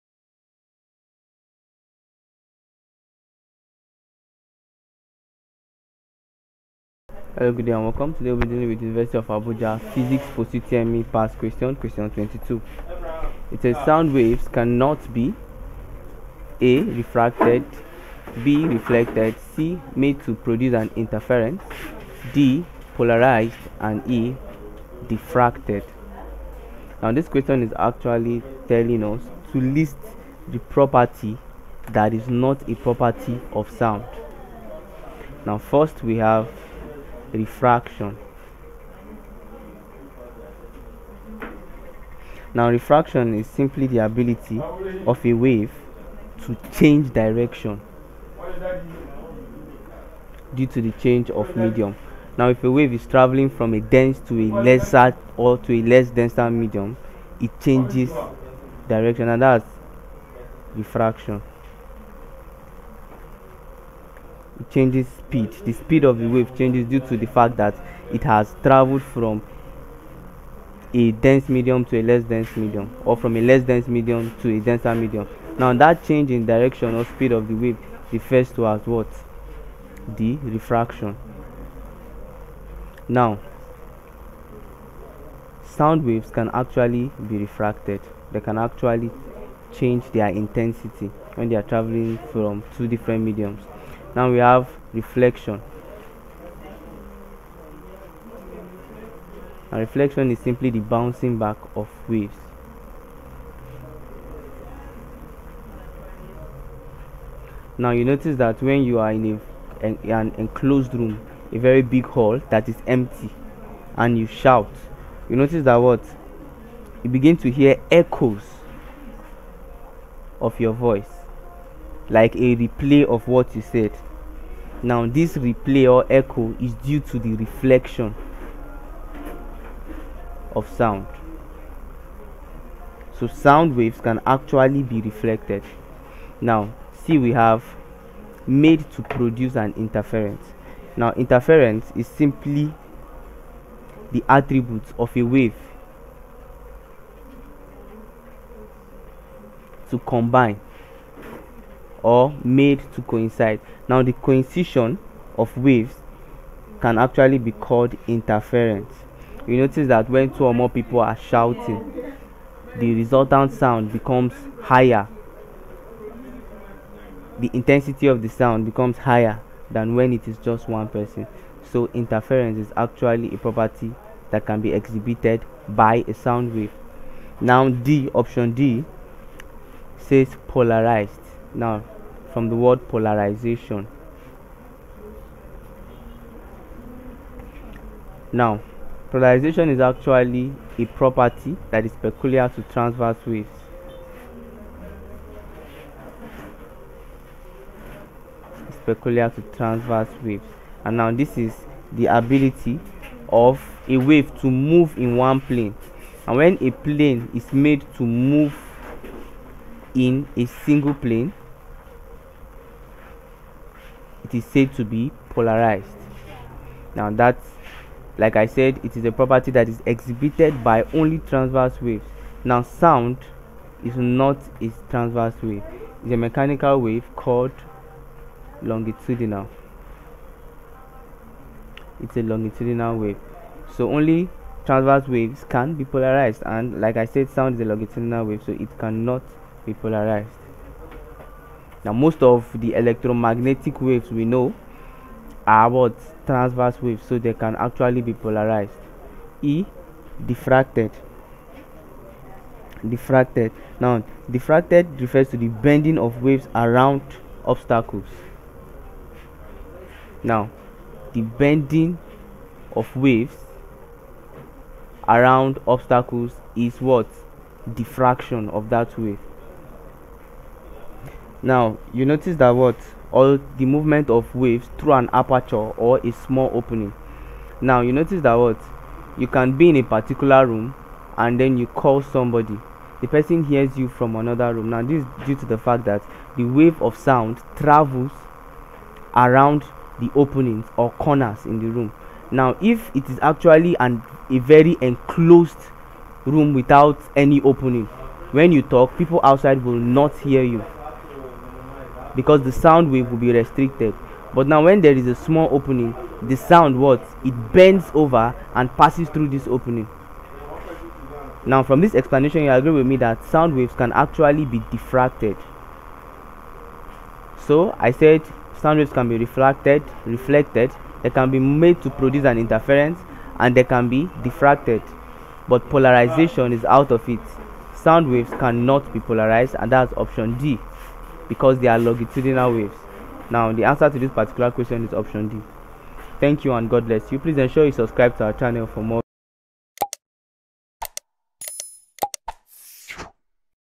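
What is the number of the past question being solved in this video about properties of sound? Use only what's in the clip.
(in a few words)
22.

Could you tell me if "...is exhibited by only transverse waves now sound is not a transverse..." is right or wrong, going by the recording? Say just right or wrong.
right.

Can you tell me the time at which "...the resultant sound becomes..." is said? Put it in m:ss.
2:42.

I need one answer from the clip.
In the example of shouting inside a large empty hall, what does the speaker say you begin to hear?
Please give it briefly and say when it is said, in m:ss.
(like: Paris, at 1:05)
echoes, at 1:57.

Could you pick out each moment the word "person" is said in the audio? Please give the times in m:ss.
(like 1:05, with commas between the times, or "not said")
2:50, 4:43.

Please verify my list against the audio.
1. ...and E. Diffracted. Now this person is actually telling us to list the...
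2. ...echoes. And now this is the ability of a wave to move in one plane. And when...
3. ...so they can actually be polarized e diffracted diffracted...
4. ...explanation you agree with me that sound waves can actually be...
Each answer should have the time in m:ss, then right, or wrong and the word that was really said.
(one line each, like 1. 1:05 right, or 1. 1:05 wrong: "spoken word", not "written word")
1. 0:23 wrong: "question", not "person"
2. 3:20 wrong: "waves", not "echoes"
3. 4:07 right
4. 5:11 right.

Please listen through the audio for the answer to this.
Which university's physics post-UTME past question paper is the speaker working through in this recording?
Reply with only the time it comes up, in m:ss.
0:08.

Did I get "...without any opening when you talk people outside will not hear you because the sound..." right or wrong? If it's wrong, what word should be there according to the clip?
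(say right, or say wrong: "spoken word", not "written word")
right.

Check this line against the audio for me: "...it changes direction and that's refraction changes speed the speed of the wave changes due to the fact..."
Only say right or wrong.
right.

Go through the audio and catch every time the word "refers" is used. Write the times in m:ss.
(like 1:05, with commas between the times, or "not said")
1:18, 4:14.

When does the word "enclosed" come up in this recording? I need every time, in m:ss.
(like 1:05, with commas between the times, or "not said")
1:50, 4:54.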